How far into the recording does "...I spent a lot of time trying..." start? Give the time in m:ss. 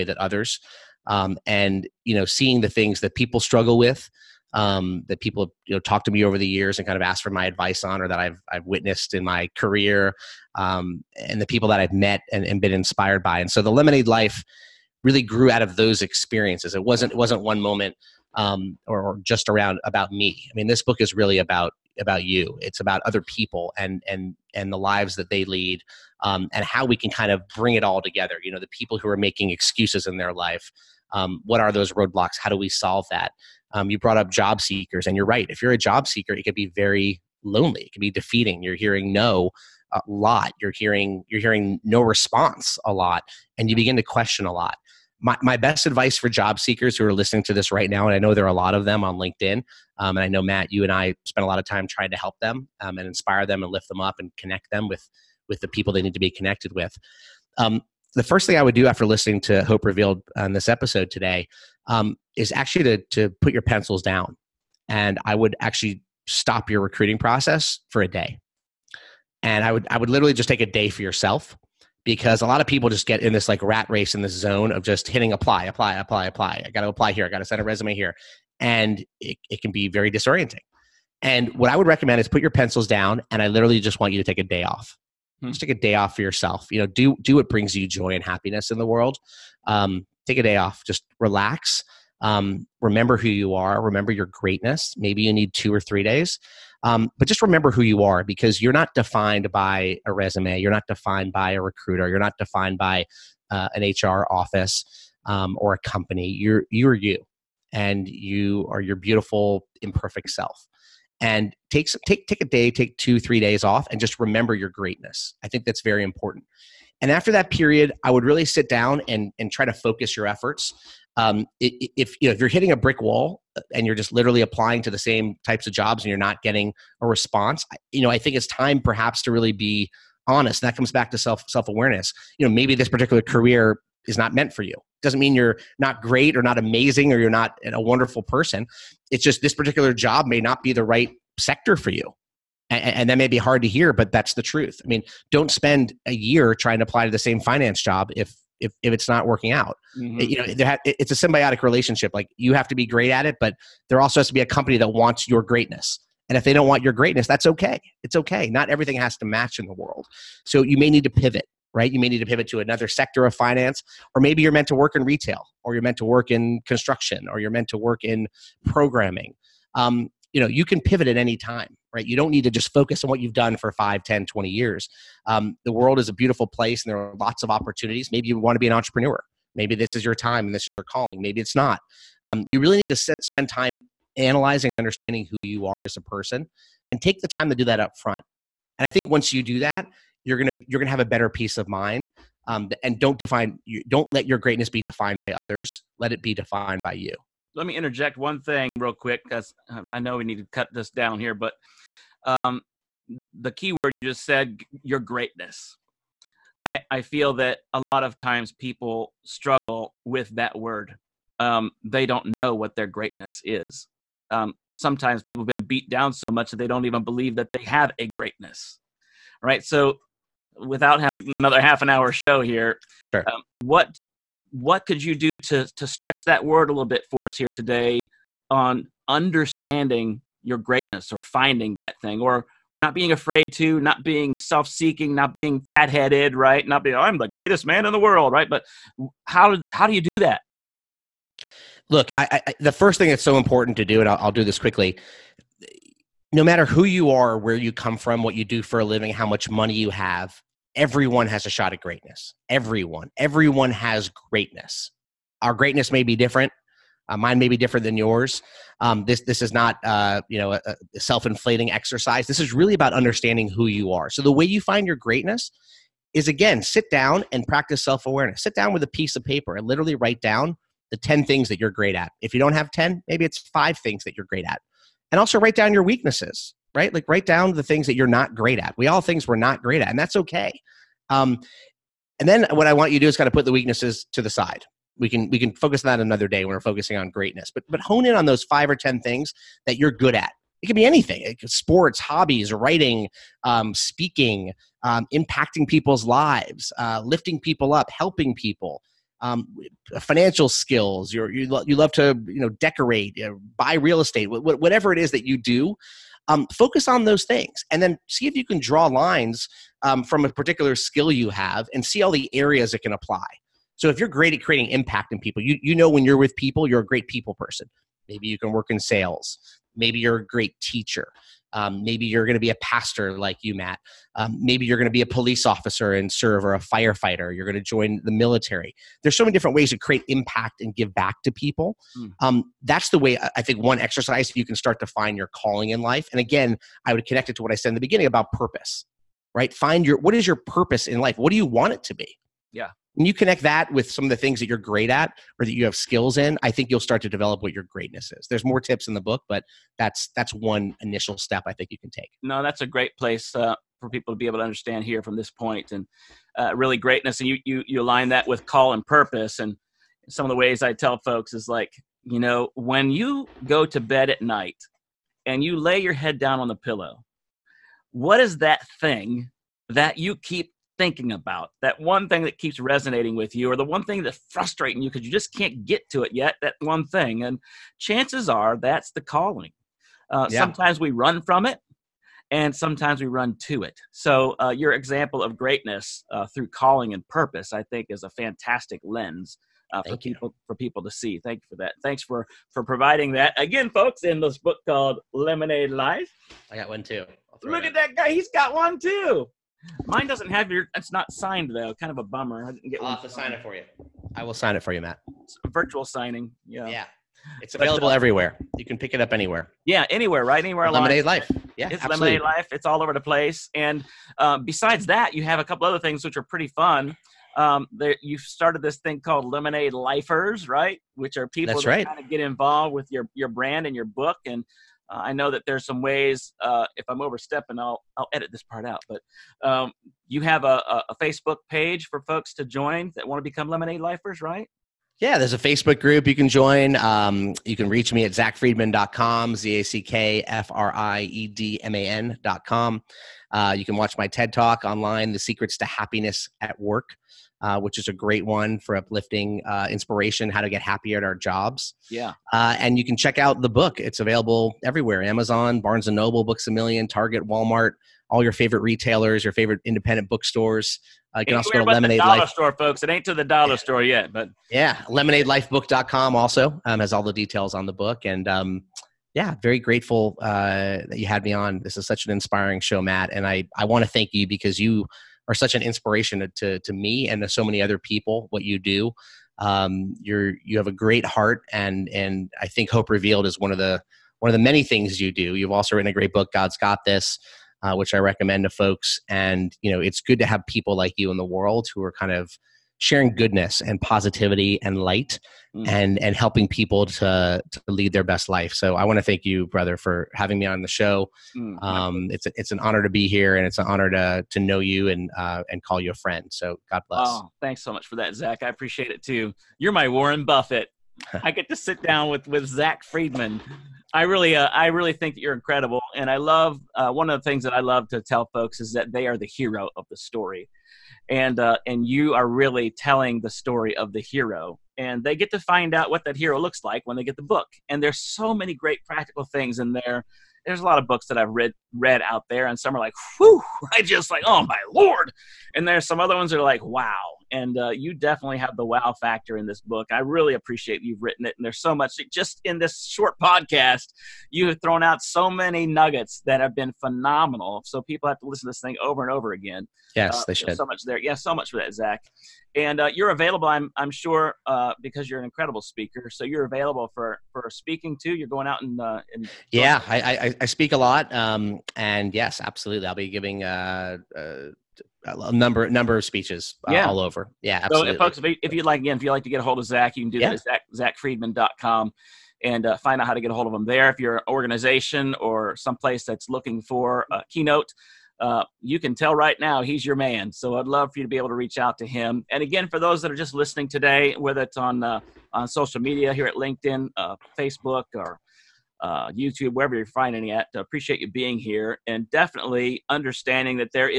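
0:50.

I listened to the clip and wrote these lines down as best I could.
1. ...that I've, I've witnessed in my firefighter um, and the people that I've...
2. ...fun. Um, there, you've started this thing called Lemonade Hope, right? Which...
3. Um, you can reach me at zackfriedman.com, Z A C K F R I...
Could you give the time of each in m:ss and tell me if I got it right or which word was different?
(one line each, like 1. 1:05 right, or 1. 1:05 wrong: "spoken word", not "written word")
1. 0:08 wrong: "career", not "firefighter"
2. 6:56 wrong: "Lifers", not "Hope"
3. 7:16 right.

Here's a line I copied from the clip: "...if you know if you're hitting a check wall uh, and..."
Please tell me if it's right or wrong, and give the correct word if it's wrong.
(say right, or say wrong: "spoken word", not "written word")
wrong: "brick", not "check".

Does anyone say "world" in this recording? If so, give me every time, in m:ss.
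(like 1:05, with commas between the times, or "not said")
1:28, 2:39, 2:55, 3:57, 8:11.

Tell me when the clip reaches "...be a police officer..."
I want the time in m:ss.
5:24.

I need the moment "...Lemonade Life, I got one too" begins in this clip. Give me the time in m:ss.
6:35.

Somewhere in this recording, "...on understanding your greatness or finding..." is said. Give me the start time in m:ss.
3:48.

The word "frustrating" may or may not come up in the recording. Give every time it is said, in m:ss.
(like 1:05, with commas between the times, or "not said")
6:14.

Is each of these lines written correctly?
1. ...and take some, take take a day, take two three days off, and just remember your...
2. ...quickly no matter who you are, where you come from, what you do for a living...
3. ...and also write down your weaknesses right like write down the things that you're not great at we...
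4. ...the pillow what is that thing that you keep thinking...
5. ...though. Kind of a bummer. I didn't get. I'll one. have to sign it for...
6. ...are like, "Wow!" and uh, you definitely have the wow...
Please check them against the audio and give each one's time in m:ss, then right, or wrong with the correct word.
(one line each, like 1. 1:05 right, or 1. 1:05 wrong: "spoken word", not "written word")
1. 1:51 right
2. 4:04 right
3. 4:35 right
4. 6:06 right
5. 6:41 right
6. 8:56 right.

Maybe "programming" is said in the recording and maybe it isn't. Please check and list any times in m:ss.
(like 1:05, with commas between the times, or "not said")
2:48.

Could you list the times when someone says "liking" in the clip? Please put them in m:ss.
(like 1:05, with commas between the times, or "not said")
not said.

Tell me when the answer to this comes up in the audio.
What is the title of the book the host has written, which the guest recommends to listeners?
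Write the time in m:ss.
8:06.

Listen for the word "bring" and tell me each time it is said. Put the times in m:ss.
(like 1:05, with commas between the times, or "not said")
0:27, 1:27.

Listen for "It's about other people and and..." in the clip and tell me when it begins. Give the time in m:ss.
0:22.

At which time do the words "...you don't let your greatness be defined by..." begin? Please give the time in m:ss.
3:13.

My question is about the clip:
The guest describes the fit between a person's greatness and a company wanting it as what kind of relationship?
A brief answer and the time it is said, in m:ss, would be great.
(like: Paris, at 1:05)
symbiotic, at 2:31.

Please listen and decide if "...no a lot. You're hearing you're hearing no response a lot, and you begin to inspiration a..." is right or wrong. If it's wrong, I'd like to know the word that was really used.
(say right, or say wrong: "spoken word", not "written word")
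wrong: "question", not "inspiration".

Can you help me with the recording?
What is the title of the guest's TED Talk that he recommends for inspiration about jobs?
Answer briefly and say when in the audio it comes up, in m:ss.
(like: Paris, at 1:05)
The Secrets to Happiness at Work, at 7:25.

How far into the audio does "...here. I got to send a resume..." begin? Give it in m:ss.
1:17.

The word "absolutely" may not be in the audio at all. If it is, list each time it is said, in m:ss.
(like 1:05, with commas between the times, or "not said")
6:51, 9:22, 9:27.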